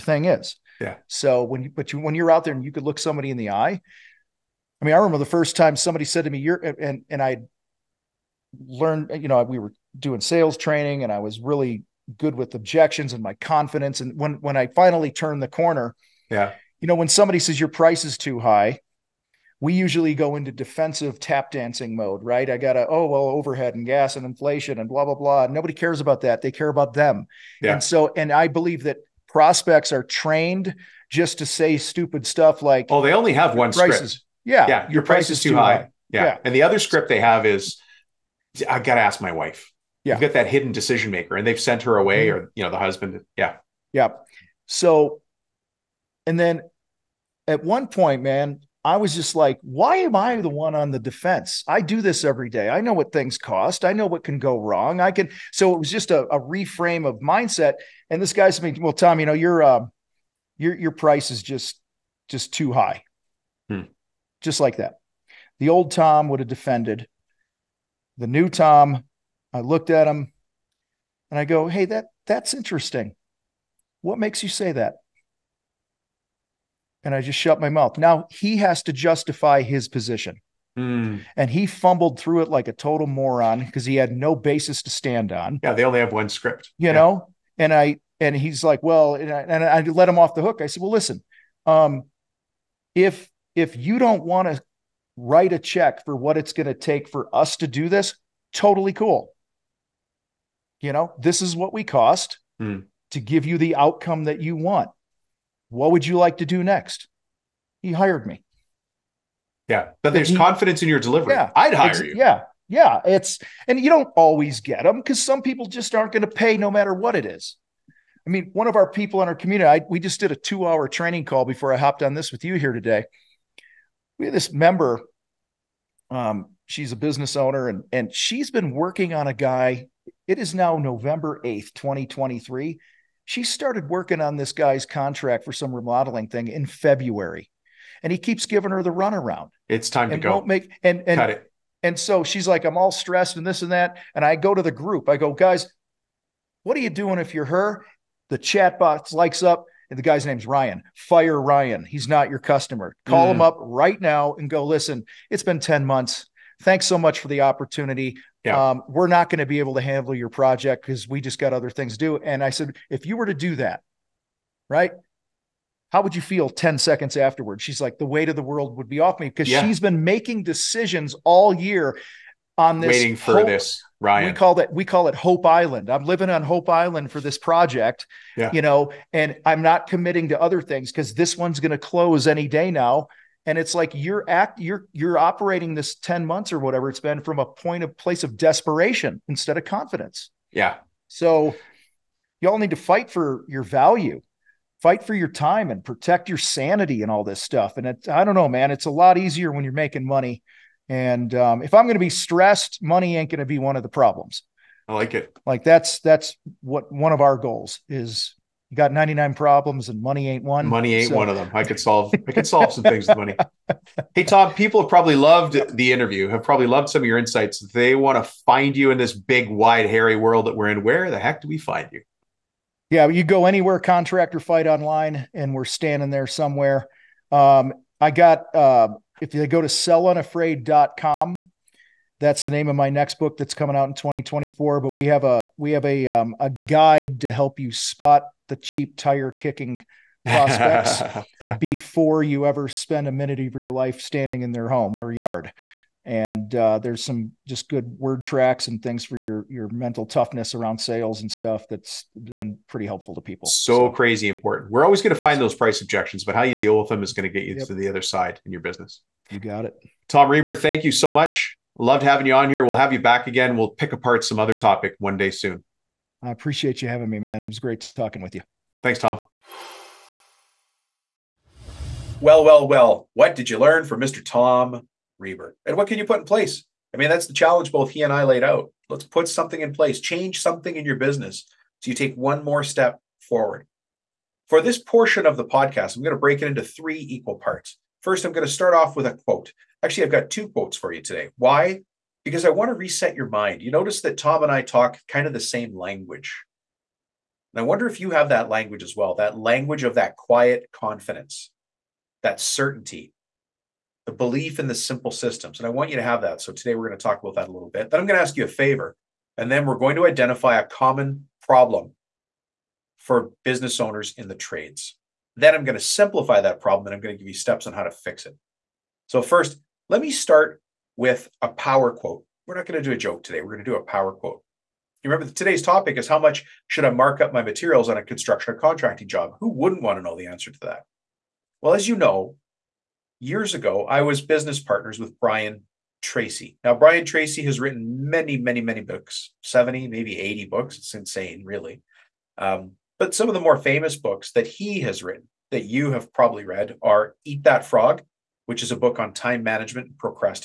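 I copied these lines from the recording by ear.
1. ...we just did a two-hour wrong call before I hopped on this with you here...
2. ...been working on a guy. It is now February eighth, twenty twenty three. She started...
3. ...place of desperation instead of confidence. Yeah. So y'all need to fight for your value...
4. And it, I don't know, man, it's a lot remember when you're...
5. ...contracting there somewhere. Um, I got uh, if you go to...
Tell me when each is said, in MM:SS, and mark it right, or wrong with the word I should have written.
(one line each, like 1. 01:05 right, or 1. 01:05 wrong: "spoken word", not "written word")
1. 01:59 wrong: "training", not "wrong"
2. 02:08 wrong: "November", not "February"
3. 03:07 right
4. 03:17 wrong: "easier", not "remember"
5. 03:45 wrong: "standing", not "contracting".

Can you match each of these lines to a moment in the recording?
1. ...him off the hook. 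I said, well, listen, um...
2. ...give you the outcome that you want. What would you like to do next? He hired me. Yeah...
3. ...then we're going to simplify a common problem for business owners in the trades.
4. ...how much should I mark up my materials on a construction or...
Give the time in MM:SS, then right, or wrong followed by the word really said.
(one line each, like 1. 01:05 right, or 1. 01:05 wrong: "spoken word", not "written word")
1. 01:30 right
2. 01:43 right
3. 05:09 wrong: "identify", not "simplify"
4. 05:26 right.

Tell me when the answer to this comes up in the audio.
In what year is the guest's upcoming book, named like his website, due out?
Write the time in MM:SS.
03:53.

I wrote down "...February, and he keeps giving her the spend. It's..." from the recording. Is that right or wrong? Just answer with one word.
wrong.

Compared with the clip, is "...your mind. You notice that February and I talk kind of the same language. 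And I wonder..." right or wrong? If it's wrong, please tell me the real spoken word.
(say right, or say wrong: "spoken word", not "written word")
wrong: "Tom", not "February".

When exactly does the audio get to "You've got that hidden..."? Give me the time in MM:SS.
00:40.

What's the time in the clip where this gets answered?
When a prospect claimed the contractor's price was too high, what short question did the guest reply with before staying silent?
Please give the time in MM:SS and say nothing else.
01:14.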